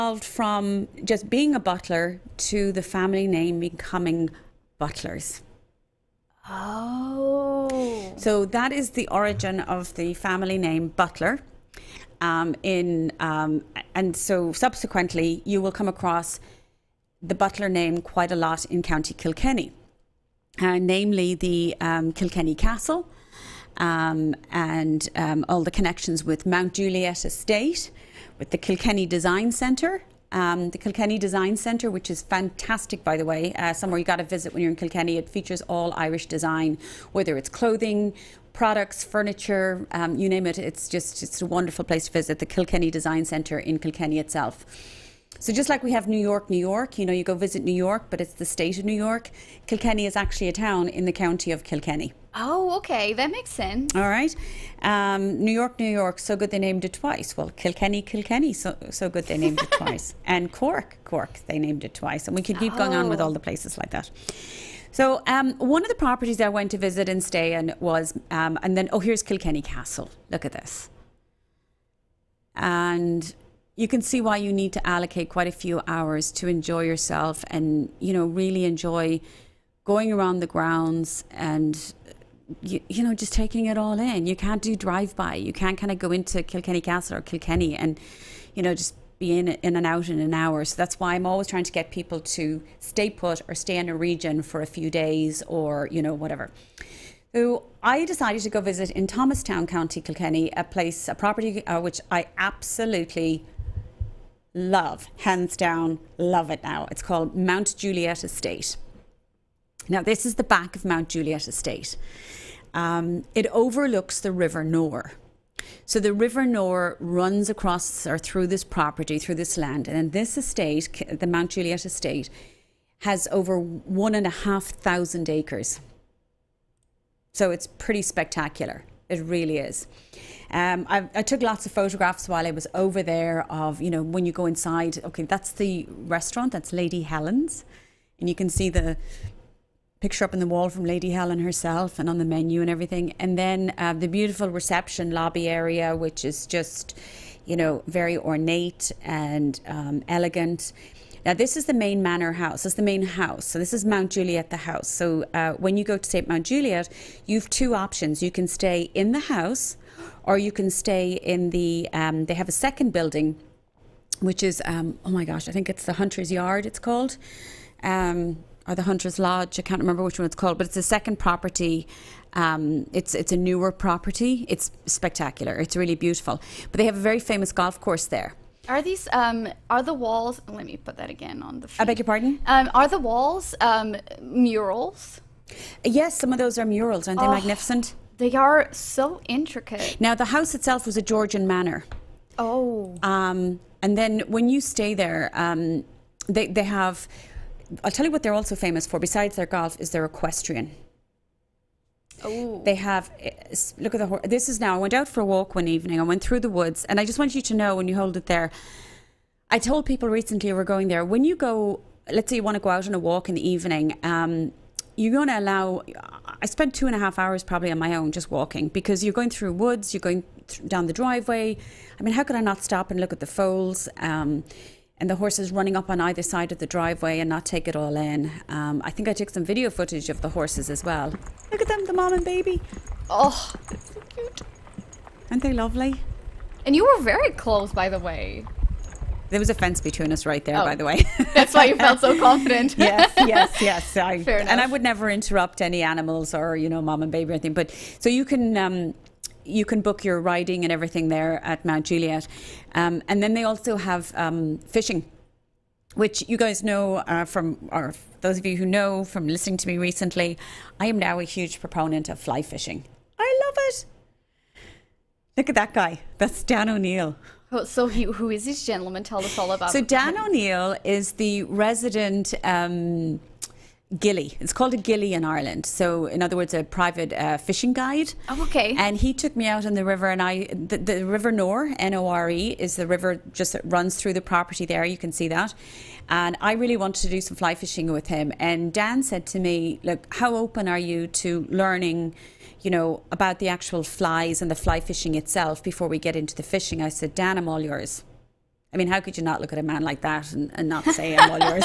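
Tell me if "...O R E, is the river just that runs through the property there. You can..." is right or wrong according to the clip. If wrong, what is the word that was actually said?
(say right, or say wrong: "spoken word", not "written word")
right.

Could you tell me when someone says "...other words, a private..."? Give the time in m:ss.
4:36.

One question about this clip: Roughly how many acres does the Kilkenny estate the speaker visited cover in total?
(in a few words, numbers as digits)
Over 1,500 acres.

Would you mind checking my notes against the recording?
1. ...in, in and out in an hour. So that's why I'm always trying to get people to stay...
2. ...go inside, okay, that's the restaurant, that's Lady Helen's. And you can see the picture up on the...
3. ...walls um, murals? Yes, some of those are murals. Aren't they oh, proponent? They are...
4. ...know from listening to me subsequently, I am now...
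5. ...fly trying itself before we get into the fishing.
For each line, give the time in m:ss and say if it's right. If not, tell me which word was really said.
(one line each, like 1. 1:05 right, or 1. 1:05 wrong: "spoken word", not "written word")
1. 1:29 right
2. 2:14 right
3. 3:02 wrong: "magnificent", not "proponent"
4. 4:18 wrong: "recently", not "subsequently"
5. 4:54 wrong: "fishing", not "trying".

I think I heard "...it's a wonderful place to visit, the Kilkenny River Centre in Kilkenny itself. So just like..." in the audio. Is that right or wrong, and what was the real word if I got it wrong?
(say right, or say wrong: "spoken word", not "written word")
wrong: "Design", not "River".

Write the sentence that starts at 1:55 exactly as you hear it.
So the River Nore runs across or through this property, through this land.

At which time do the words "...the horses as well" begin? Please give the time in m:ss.
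3:50.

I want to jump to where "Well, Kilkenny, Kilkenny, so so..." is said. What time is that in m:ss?
0:57.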